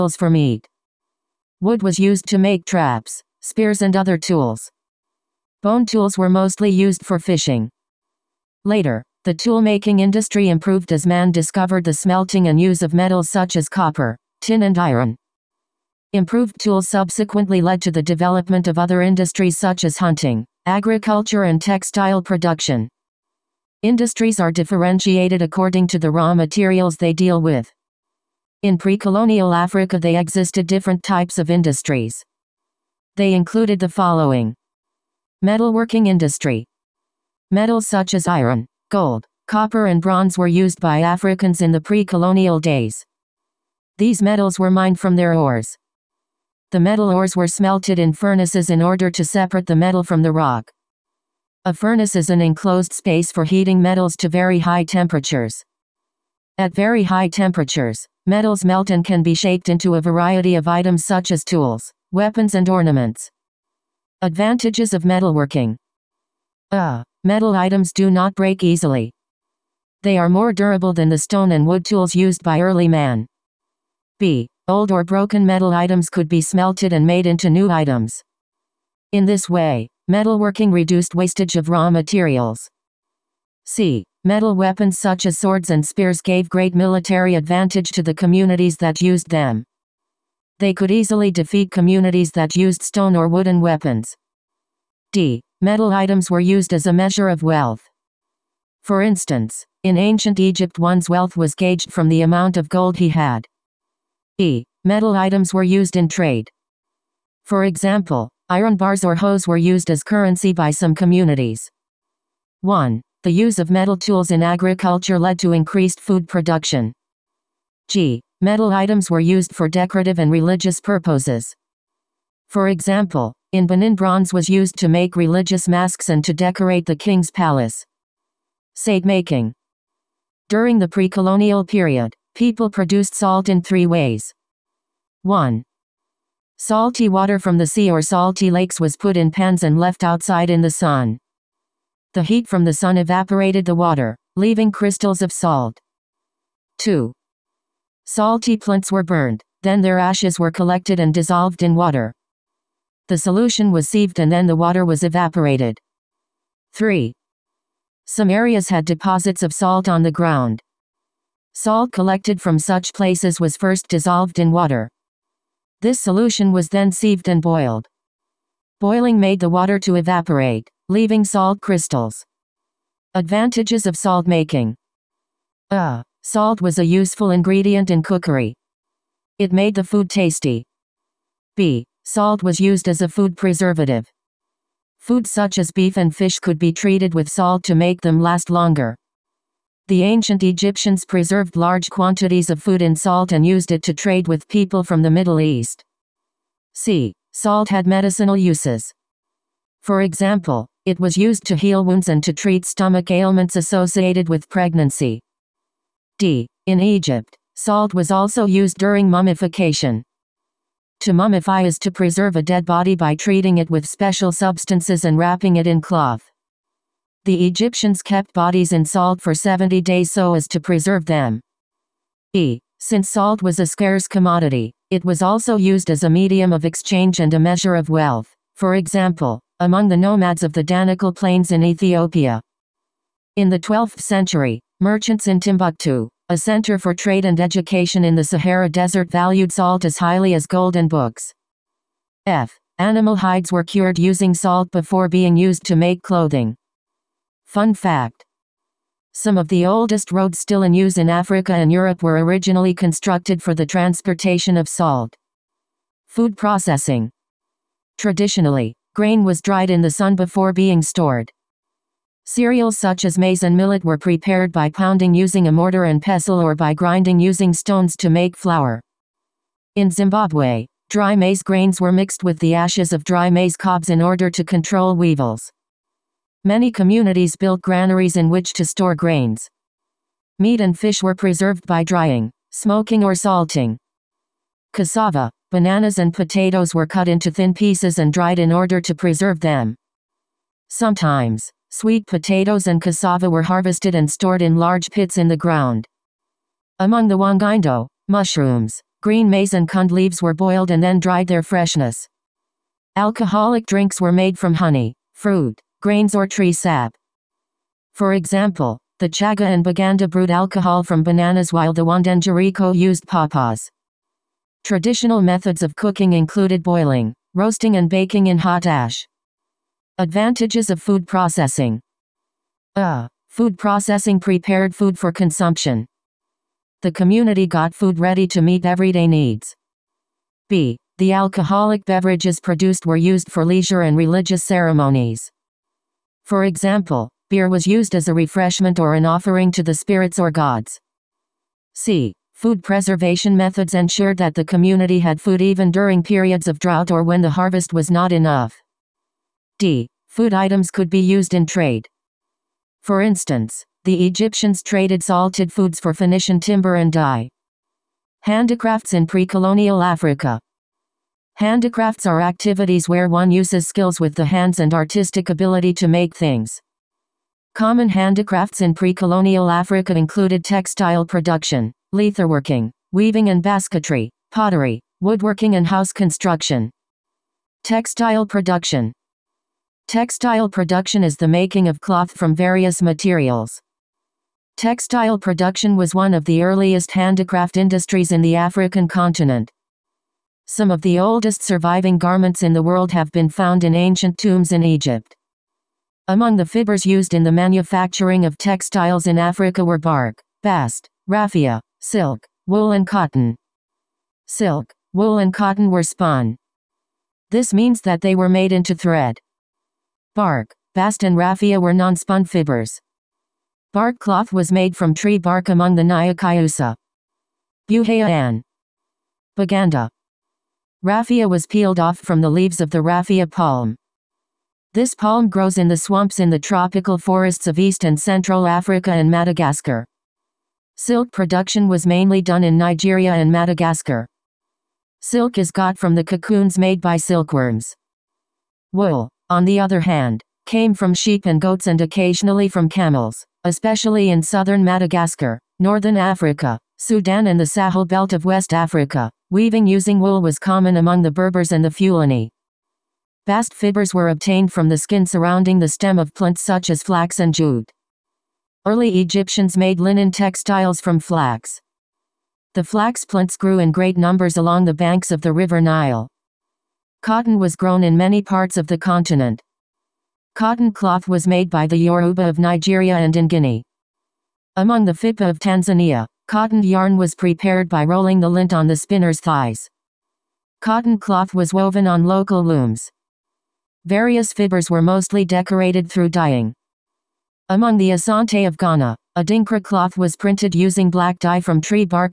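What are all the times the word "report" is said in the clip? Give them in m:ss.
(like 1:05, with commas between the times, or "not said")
not said.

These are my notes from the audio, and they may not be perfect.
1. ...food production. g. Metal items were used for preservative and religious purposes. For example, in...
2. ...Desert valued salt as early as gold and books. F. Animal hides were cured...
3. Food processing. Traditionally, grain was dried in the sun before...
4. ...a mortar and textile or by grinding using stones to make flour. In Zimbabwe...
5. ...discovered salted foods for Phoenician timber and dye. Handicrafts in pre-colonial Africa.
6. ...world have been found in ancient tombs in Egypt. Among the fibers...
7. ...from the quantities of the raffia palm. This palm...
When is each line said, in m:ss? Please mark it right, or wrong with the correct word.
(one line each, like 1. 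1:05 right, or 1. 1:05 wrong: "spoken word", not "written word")
1. 1:56 wrong: "decorative", not "preservative"
2. 3:58 wrong: "highly", not "early"
3. 4:16 right
4. 4:25 wrong: "pestle", not "textile"
5. 5:54 wrong: "traded", not "discovered"
6. 6:32 right
7. 7:01 wrong: "leaves", not "quantities".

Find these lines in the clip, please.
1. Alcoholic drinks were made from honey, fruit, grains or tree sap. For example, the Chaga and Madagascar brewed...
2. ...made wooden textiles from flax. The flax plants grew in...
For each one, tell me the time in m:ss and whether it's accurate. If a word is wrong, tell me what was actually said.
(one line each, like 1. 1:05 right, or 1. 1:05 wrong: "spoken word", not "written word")
1. 5:02 wrong: "Baganda", not "Madagascar"
2. 7:39 wrong: "linen", not "wooden".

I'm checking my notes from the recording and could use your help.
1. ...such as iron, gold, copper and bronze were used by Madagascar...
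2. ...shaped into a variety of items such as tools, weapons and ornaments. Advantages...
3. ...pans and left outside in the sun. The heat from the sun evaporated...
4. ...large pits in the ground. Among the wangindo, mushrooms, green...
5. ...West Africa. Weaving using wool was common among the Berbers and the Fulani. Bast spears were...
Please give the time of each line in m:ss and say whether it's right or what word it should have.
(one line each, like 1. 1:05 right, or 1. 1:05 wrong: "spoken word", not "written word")
1. 0:37 wrong: "Africans", not "Madagascar"
2. 0:59 right
3. 2:19 right
4. 4:54 right
5. 7:28 wrong: "fibers", not "spears".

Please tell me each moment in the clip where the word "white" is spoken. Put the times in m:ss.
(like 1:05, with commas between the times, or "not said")
not said.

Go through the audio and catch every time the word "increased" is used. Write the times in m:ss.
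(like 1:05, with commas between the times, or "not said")
1:55.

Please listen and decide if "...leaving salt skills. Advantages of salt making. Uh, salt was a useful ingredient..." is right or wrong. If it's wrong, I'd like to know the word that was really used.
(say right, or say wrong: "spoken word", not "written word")
wrong: "crystals", not "skills".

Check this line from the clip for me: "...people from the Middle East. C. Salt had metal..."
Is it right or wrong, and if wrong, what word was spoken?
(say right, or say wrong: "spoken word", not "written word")
wrong: "medicinal", not "metal".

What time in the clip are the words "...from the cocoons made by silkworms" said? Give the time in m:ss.
7:15.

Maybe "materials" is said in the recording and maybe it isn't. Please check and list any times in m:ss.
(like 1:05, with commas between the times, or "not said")
0:26, 1:21, 6:22.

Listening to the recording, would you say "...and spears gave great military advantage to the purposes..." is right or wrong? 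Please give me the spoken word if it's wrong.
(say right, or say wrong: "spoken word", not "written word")
wrong: "communities", not "purposes".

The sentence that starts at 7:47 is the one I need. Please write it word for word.
Cotton was grown in many parts of the continent.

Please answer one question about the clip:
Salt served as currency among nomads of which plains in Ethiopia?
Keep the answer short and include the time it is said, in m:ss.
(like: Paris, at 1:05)
Danakil Plains, at 3:50.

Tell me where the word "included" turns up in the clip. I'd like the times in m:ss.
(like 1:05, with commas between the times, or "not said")
0:33, 5:16, 6:09.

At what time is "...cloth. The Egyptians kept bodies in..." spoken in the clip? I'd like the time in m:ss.
3:35.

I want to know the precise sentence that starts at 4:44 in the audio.
Cassava, bananas and potatoes were cut into thin pieces and dried in order to preserve them.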